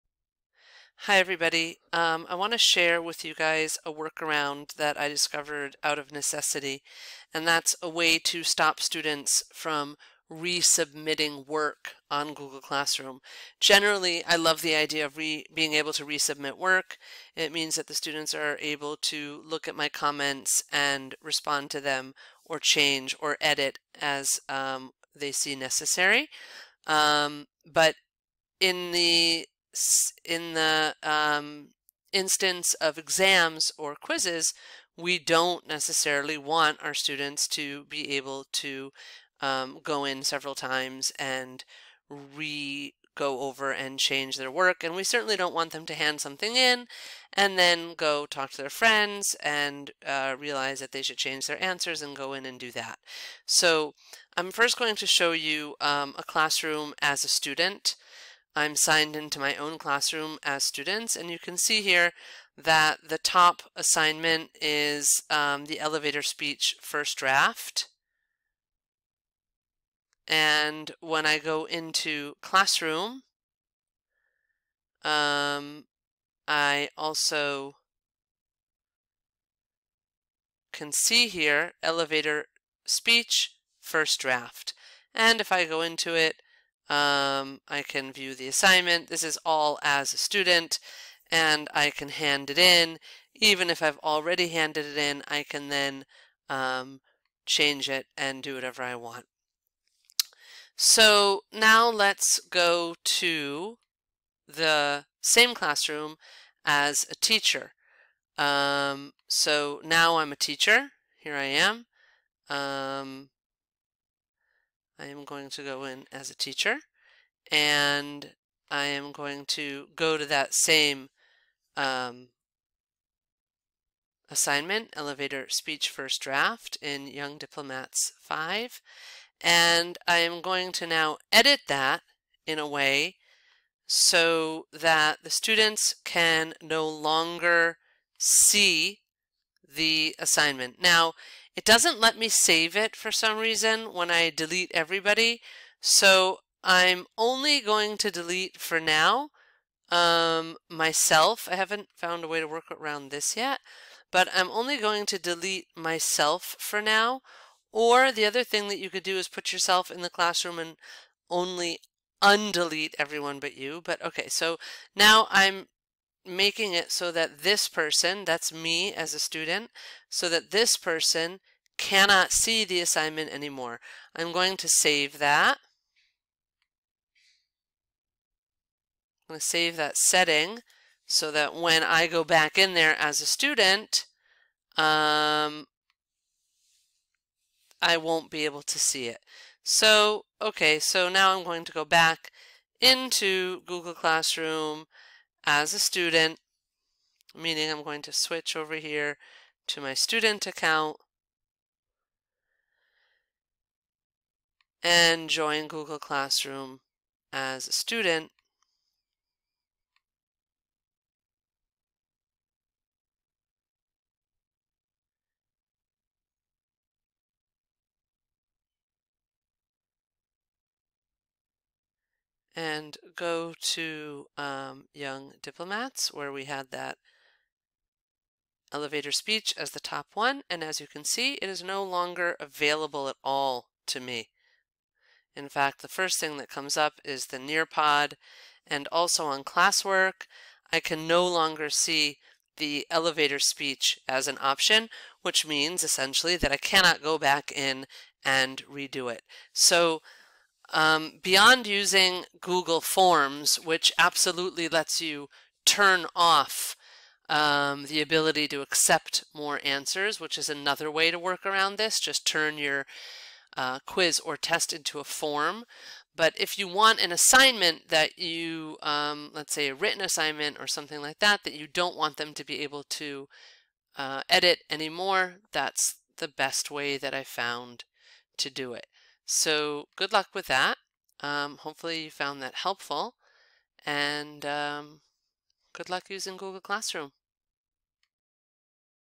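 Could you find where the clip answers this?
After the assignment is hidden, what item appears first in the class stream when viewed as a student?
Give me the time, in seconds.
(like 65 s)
237 s.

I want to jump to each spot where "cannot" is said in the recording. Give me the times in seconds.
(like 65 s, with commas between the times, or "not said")
171 s, 246 s.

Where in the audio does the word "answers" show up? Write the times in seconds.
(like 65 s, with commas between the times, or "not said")
51 s, 259 s.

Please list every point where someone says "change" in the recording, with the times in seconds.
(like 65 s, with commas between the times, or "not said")
22 s, 43 s, 51 s, 97 s.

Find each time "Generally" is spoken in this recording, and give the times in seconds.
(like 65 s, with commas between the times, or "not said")
13 s.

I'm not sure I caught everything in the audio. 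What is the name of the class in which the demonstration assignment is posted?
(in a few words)
Young Diplomats 5.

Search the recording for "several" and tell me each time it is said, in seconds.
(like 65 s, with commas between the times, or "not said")
40 s.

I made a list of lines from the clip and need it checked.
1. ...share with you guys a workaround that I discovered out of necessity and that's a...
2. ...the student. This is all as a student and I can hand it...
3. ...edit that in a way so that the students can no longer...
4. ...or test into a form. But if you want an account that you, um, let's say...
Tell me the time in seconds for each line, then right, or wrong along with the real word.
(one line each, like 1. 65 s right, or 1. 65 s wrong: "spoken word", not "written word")
1. 2 s right
2. 88 s wrong: "assignment", not "student"
3. 131 s right
4. 264 s wrong: "assignment", not "account".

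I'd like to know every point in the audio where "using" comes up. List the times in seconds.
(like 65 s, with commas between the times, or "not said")
251 s, 286 s.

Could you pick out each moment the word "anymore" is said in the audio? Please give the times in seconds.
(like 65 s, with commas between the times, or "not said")
173 s, 274 s.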